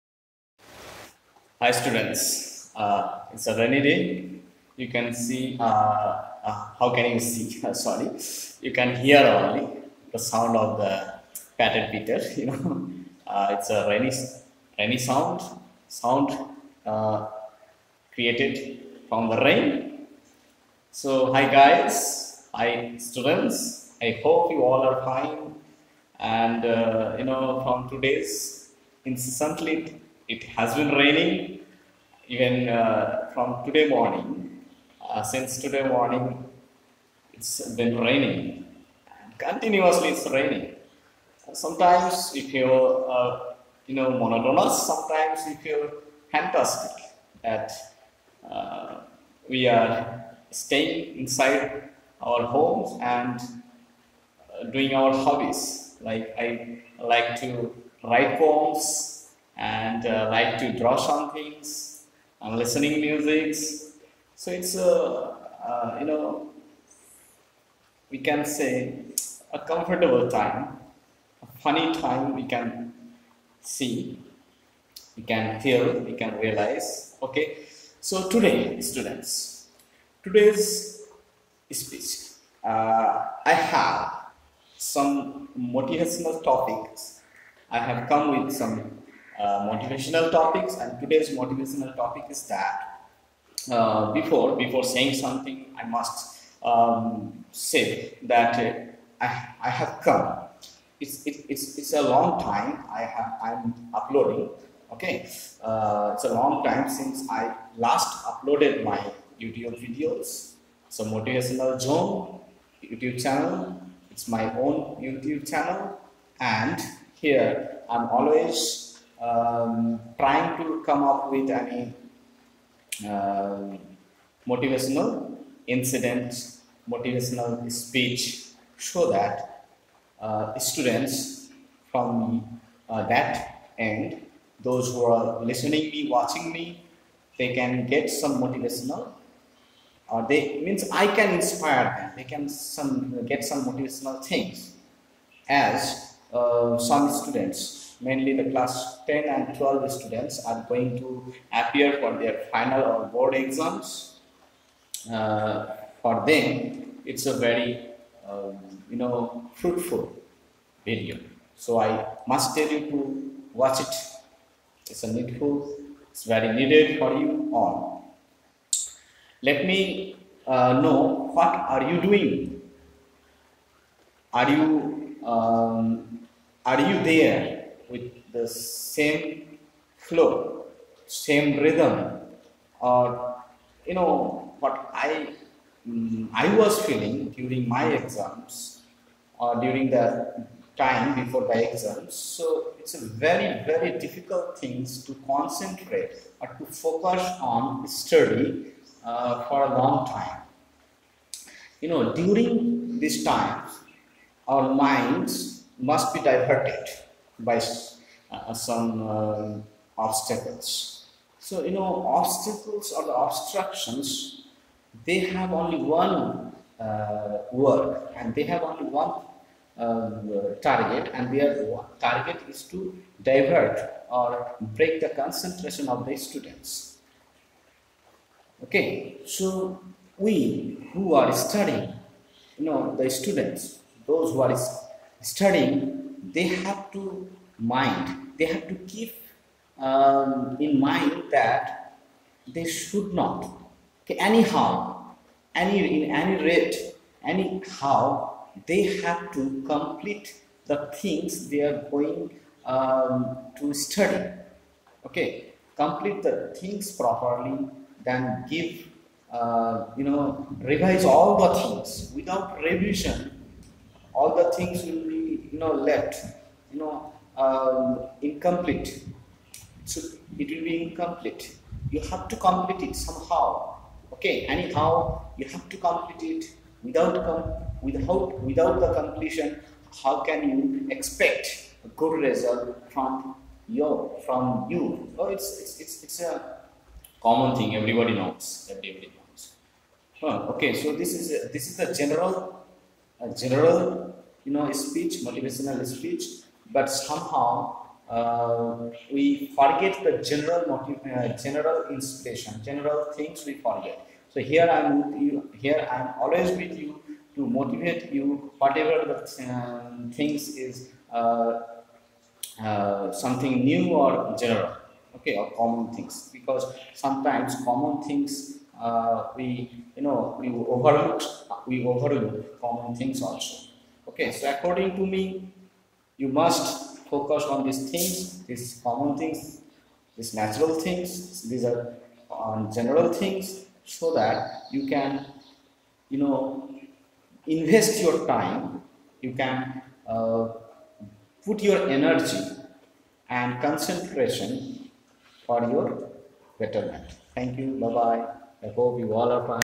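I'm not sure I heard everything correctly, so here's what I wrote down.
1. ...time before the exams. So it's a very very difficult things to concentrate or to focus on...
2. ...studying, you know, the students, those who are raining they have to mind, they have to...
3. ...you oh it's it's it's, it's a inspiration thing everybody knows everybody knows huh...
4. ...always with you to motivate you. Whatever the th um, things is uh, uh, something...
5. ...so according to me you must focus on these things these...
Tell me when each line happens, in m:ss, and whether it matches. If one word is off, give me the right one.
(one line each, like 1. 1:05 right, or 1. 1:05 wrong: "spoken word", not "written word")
1. 3:10 right
2. 3:51 wrong: "studying", not "raining"
3. 4:44 wrong: "common", not "inspiration"
4. 5:06 right
5. 5:24 right.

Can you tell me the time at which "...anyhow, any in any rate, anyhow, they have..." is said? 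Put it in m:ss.
4:04.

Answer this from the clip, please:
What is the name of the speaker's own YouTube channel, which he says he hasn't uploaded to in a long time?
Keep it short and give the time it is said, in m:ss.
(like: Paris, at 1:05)
Motivational Zone, at 1:51.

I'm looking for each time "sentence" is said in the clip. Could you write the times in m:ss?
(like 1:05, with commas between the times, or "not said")
not said.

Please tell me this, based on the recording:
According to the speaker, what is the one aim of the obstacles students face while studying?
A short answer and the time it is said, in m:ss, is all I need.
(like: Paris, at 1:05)
Break the concentration, at 3:44.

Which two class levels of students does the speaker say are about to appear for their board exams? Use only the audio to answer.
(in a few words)
10 and 12.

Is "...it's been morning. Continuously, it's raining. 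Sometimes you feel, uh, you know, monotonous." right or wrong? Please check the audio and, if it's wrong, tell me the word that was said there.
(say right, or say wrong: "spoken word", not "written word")
wrong: "raining", not "morning".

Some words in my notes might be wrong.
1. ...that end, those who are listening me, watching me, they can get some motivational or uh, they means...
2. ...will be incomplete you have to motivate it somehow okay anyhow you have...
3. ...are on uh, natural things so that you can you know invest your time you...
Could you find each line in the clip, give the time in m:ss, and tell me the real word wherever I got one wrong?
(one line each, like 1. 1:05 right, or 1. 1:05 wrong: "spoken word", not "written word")
1. 2:13 right
2. 4:30 wrong: "complete", not "motivate"
3. 5:31 wrong: "general", not "natural".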